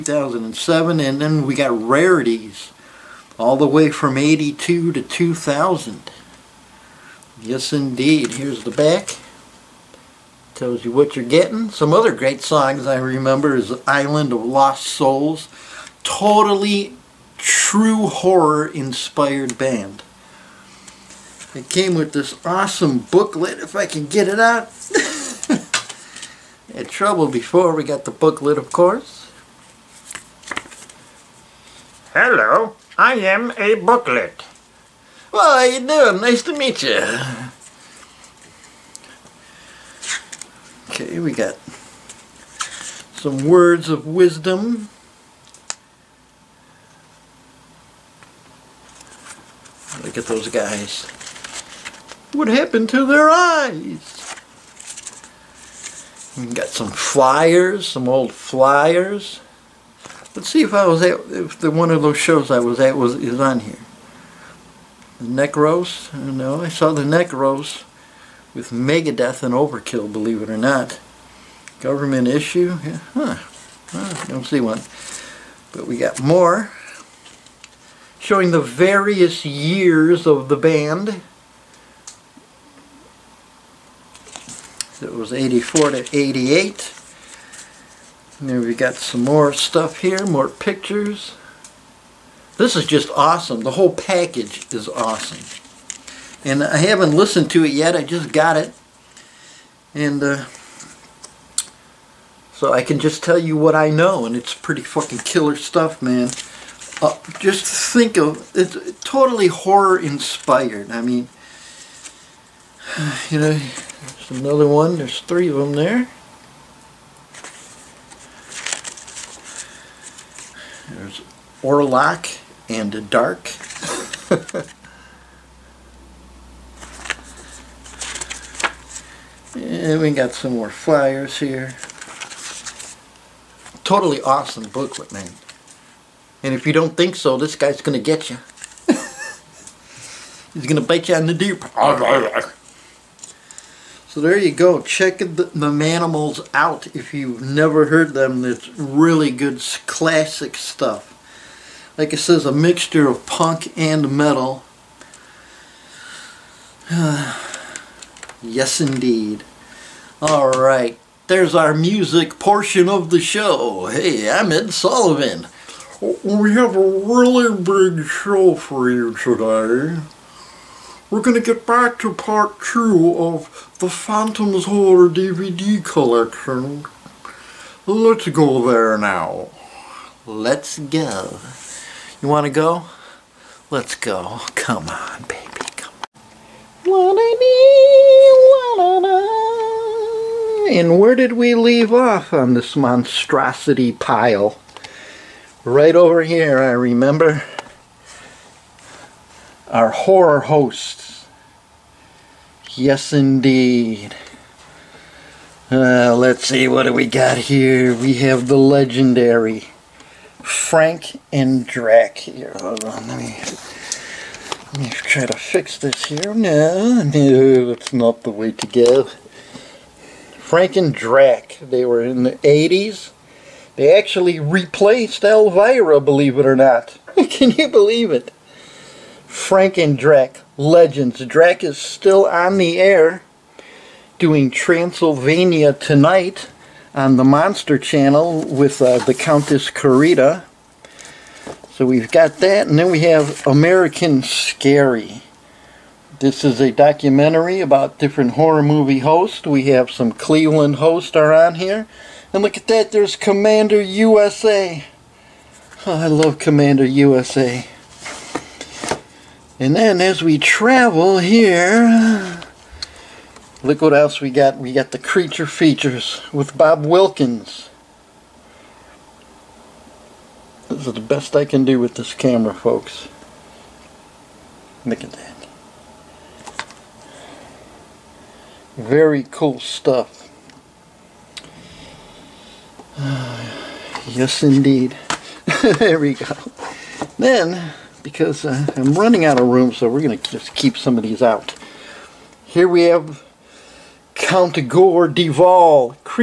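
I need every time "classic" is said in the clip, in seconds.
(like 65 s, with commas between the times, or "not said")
149 s.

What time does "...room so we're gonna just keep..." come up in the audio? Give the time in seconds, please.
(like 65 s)
289 s.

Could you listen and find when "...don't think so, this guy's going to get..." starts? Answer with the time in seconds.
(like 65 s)
136 s.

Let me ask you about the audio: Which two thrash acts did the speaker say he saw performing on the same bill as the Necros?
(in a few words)
Megadeth and Overkill.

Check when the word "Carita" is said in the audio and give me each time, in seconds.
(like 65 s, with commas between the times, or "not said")
239 s.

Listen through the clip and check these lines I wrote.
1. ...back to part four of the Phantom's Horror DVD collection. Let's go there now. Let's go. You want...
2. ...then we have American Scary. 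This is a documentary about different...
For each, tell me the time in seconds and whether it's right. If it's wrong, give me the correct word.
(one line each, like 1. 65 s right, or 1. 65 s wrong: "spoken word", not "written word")
1. 171 s wrong: "two", not "four"
2. 242 s right.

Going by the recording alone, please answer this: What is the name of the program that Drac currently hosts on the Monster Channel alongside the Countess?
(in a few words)
Transylvania Tonight.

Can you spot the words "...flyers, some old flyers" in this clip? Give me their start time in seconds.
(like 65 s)
56 s.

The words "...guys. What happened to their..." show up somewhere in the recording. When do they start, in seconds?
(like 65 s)
50 s.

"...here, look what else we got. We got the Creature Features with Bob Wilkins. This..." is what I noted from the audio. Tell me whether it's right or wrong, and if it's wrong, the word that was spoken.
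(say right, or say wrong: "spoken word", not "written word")
right.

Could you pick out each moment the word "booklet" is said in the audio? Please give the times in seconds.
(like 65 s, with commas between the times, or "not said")
22 s, 28 s, 33 s, 134 s.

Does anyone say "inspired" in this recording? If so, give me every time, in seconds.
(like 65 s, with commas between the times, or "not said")
18 s, 109 s.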